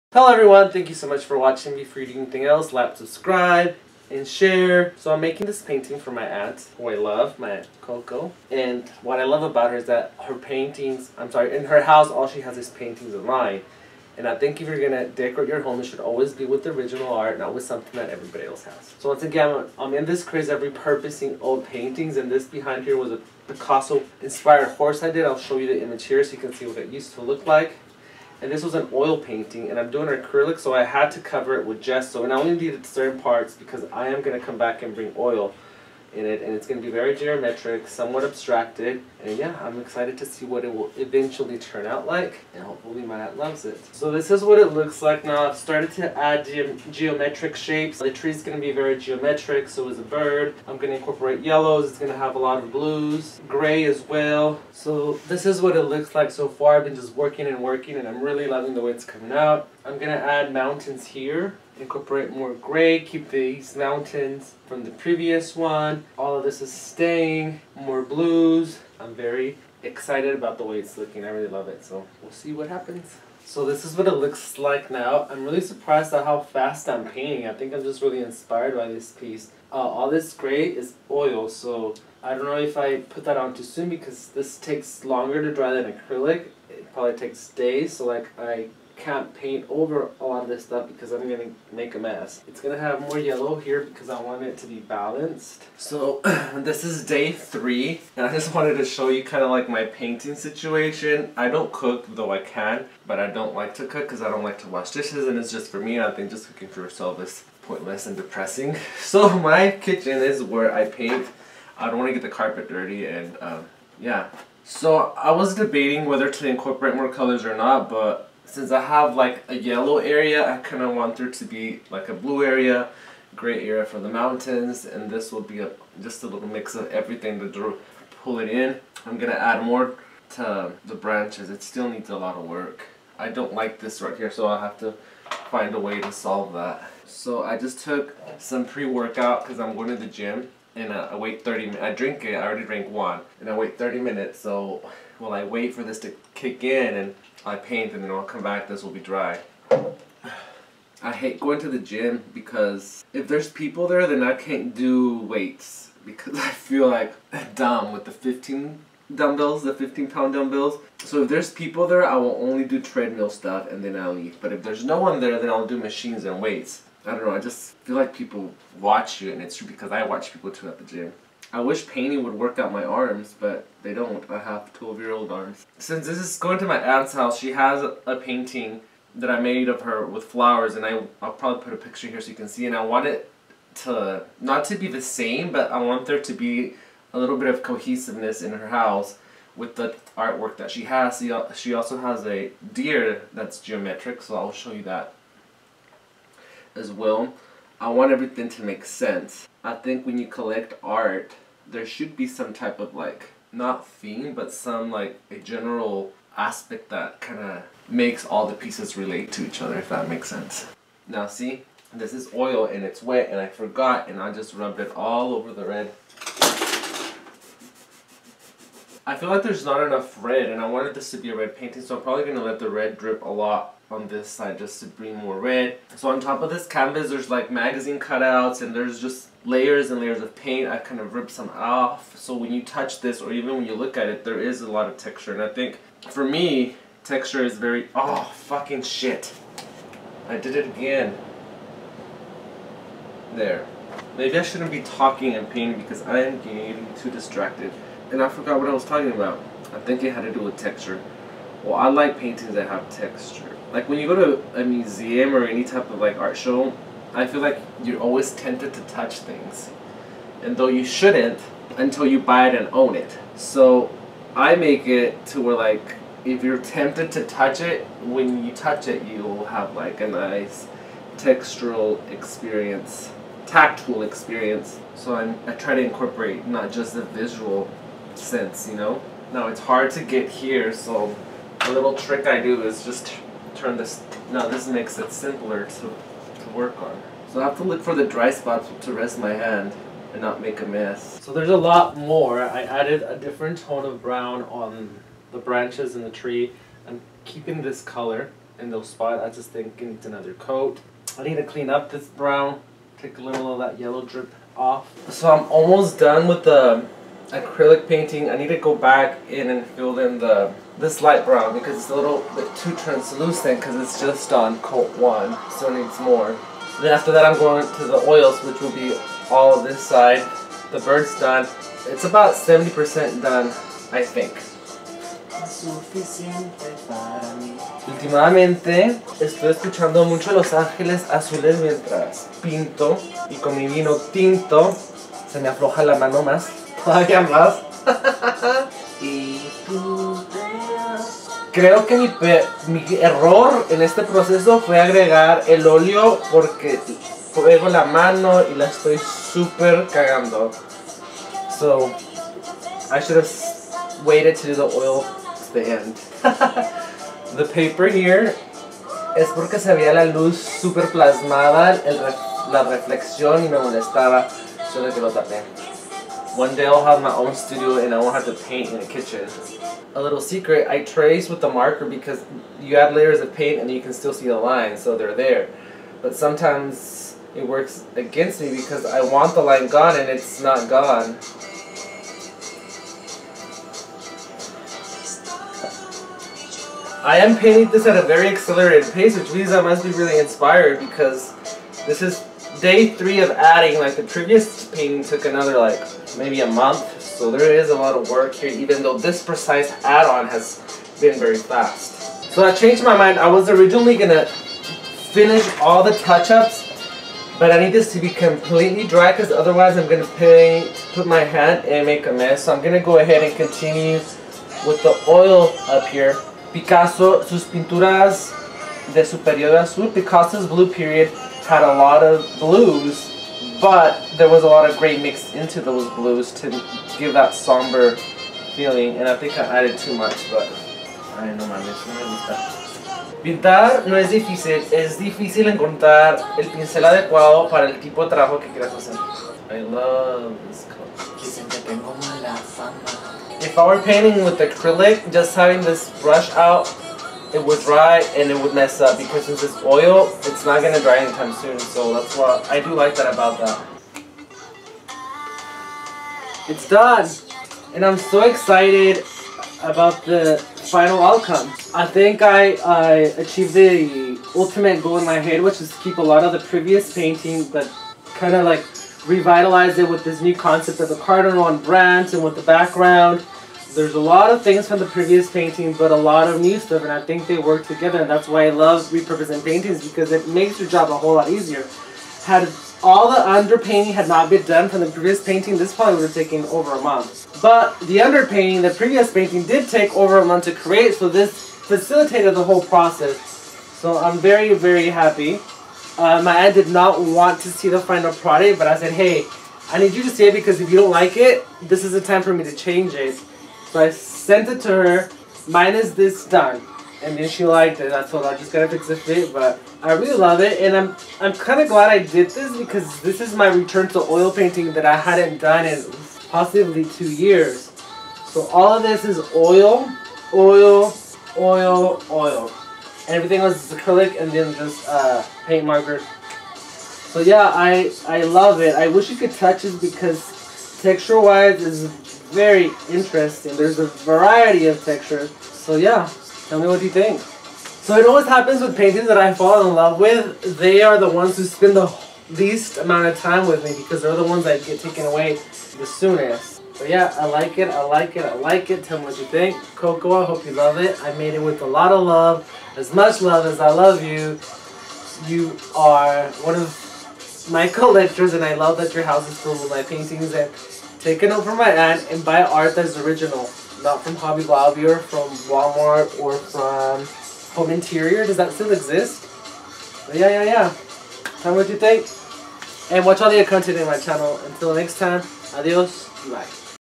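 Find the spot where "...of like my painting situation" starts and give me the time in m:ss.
1:39.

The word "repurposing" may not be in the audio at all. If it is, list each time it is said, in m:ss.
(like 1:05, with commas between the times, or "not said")
0:20, 7:58.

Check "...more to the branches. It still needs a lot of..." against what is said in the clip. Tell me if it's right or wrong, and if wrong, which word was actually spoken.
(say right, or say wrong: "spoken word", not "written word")
right.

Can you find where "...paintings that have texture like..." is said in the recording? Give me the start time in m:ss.
4:12.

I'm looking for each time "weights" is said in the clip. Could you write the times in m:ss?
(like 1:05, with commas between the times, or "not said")
2:35, 2:46.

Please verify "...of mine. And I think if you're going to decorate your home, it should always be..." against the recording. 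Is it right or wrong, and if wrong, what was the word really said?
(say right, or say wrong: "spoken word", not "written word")
right.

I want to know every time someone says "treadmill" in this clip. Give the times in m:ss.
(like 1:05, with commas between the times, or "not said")
2:42.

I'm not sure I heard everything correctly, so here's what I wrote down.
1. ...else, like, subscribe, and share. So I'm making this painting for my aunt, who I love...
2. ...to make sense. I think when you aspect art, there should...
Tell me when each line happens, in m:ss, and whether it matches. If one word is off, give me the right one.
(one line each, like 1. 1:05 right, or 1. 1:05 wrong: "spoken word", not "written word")
1. 0:02 right
2. 3:18 wrong: "collect", not "aspect".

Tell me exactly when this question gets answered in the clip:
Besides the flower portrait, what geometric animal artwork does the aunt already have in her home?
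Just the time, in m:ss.
3:12.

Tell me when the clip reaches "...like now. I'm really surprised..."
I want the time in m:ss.
1:14.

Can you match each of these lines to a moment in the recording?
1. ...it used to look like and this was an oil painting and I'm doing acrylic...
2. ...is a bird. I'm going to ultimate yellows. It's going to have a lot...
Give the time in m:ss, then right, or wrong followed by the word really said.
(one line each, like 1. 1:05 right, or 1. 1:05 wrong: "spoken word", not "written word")
1. 0:26 right
2. 0:49 wrong: "incorporate", not "ultimate".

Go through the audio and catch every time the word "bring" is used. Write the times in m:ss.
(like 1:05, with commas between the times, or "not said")
0:34, 3:44.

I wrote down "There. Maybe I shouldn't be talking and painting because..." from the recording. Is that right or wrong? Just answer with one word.
right.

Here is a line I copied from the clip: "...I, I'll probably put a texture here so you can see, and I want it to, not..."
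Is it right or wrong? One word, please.
wrong.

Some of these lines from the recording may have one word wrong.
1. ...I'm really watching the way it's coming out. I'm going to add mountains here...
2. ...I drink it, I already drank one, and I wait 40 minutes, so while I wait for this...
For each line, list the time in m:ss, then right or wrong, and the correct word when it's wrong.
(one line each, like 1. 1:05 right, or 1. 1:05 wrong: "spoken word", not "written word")
1. 0:58 wrong: "loving", not "watching"
2. 2:21 wrong: "30", not "40".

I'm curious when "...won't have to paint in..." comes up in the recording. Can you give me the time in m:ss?
6:07.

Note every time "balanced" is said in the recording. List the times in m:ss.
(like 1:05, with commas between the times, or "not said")
1:34.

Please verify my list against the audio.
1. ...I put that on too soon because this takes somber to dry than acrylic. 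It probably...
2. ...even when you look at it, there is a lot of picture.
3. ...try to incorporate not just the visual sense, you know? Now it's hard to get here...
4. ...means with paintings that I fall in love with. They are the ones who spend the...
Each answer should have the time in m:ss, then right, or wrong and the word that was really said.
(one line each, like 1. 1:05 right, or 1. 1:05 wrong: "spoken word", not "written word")
1. 1:22 wrong: "longer", not "somber"
2. 3:53 wrong: "texture", not "picture"
3. 4:35 right
4. 8:58 wrong: "happens", not "means".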